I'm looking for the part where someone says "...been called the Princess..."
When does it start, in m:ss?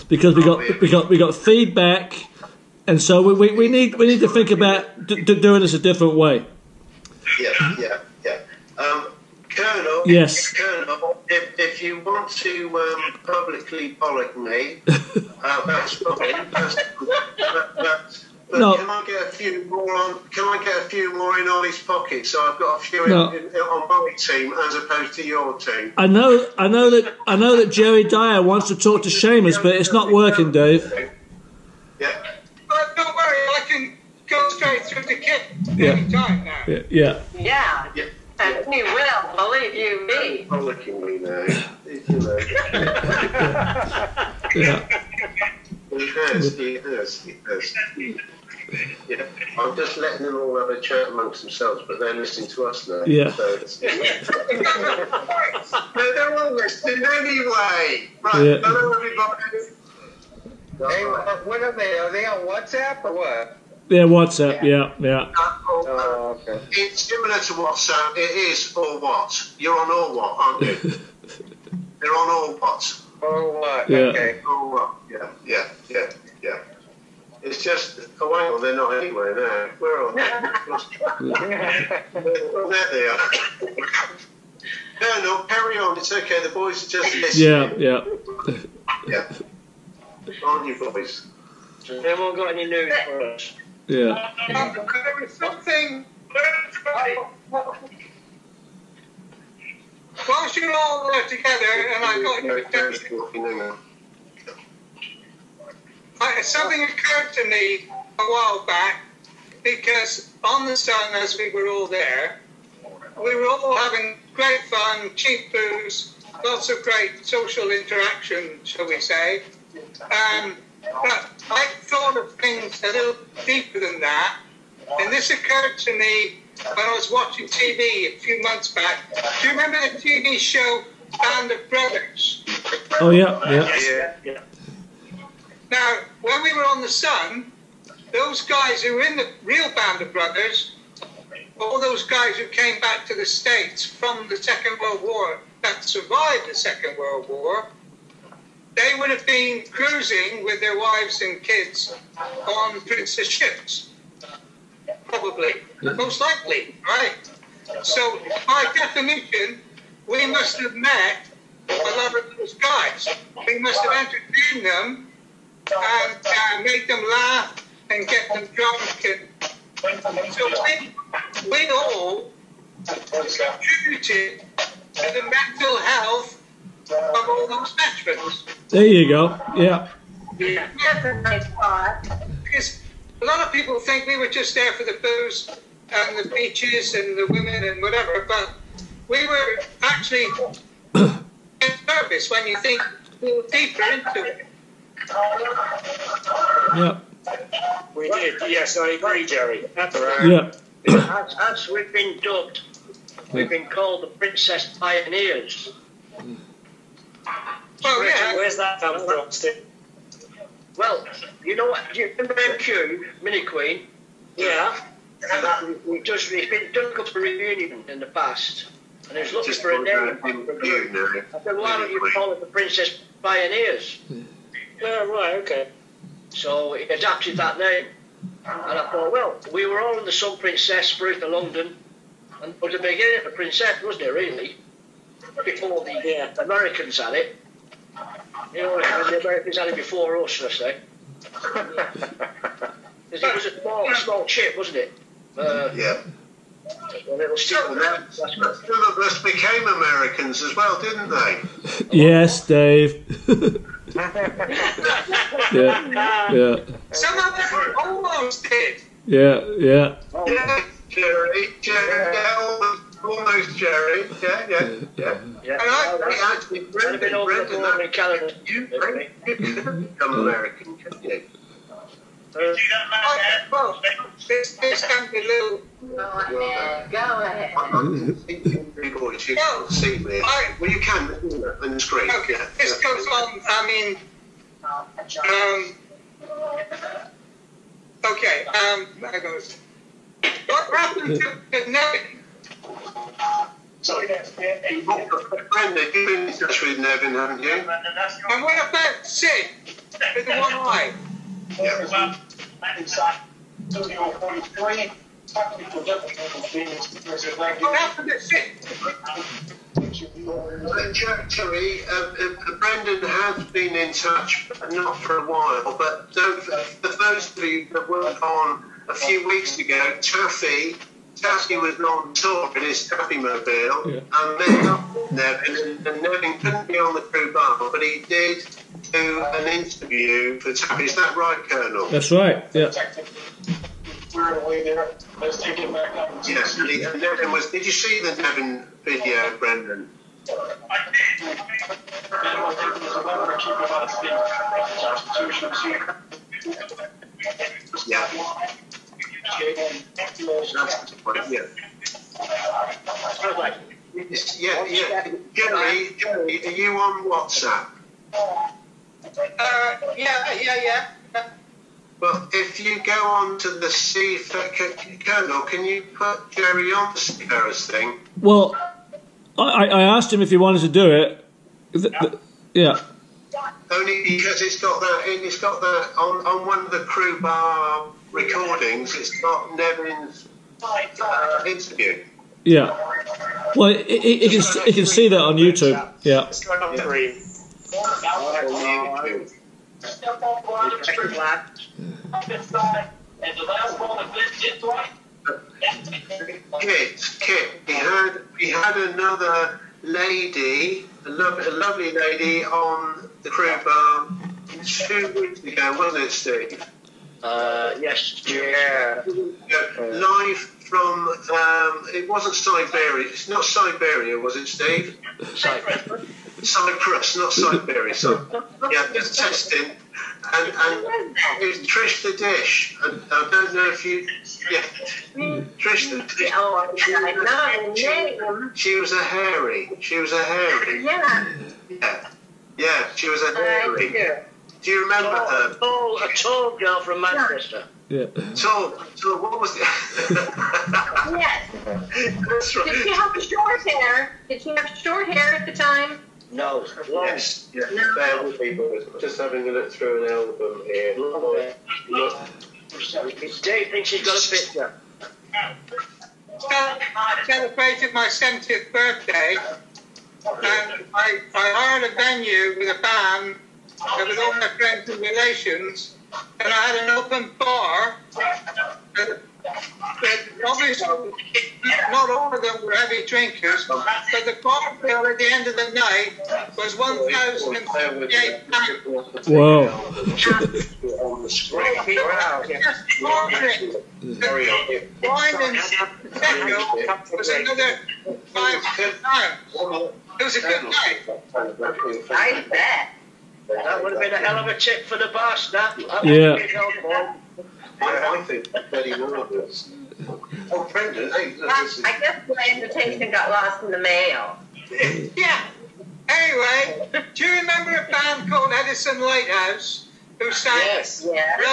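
3:23.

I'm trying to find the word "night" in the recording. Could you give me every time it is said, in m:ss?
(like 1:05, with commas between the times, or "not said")
7:55, 8:10.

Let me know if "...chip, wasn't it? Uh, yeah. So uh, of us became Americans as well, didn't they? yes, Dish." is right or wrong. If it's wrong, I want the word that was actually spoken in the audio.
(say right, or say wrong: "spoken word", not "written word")
wrong: "Dave", not "Dish".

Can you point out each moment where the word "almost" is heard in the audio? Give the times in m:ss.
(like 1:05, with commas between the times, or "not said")
4:17, 4:23.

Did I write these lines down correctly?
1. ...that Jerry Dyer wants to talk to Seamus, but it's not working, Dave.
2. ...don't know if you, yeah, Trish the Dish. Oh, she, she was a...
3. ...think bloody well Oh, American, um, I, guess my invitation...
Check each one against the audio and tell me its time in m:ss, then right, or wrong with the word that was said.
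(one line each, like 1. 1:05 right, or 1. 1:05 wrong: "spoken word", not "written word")
1. 0:27 right
2. 7:03 right
3. 8:18 wrong: "Brendan", not "American".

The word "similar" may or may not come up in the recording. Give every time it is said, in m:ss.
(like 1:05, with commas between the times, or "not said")
1:07.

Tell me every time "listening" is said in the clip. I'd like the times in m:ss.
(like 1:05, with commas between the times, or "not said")
0:52, 0:56, 1:27.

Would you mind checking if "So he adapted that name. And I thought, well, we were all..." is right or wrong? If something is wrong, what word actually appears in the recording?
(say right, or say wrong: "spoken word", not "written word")
right.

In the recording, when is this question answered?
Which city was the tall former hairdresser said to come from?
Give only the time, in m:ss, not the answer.
7:17.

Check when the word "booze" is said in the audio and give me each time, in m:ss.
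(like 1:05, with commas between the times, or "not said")
1:55, 3:05.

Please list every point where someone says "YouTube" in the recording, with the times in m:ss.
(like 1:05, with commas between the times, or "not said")
6:25.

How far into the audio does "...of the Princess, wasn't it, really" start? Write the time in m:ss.
3:53.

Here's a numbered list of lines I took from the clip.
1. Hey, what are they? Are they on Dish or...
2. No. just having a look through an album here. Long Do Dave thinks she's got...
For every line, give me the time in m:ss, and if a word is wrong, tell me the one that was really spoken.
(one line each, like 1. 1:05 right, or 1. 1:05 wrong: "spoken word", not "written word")
1. 1:00 wrong: "WhatsApp", not "Dish"
2. 7:27 right.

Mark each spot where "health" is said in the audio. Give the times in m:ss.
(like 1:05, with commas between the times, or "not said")
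2:55.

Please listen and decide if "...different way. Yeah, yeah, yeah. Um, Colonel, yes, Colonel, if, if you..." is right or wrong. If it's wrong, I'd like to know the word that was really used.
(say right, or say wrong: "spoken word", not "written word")
right.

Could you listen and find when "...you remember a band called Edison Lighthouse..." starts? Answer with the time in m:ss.
8:27.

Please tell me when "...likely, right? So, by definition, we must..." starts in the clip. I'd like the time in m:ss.
2:36.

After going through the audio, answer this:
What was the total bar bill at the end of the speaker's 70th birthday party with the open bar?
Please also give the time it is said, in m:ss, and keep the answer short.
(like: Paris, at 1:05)
1,038, at 7:56.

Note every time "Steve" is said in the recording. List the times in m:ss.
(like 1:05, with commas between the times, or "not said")
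3:29, 6:46, 6:54.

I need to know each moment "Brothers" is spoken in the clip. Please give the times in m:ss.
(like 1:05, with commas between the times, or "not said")
2:11, 2:20.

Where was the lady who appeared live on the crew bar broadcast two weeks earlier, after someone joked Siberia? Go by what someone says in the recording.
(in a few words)
Cyprus.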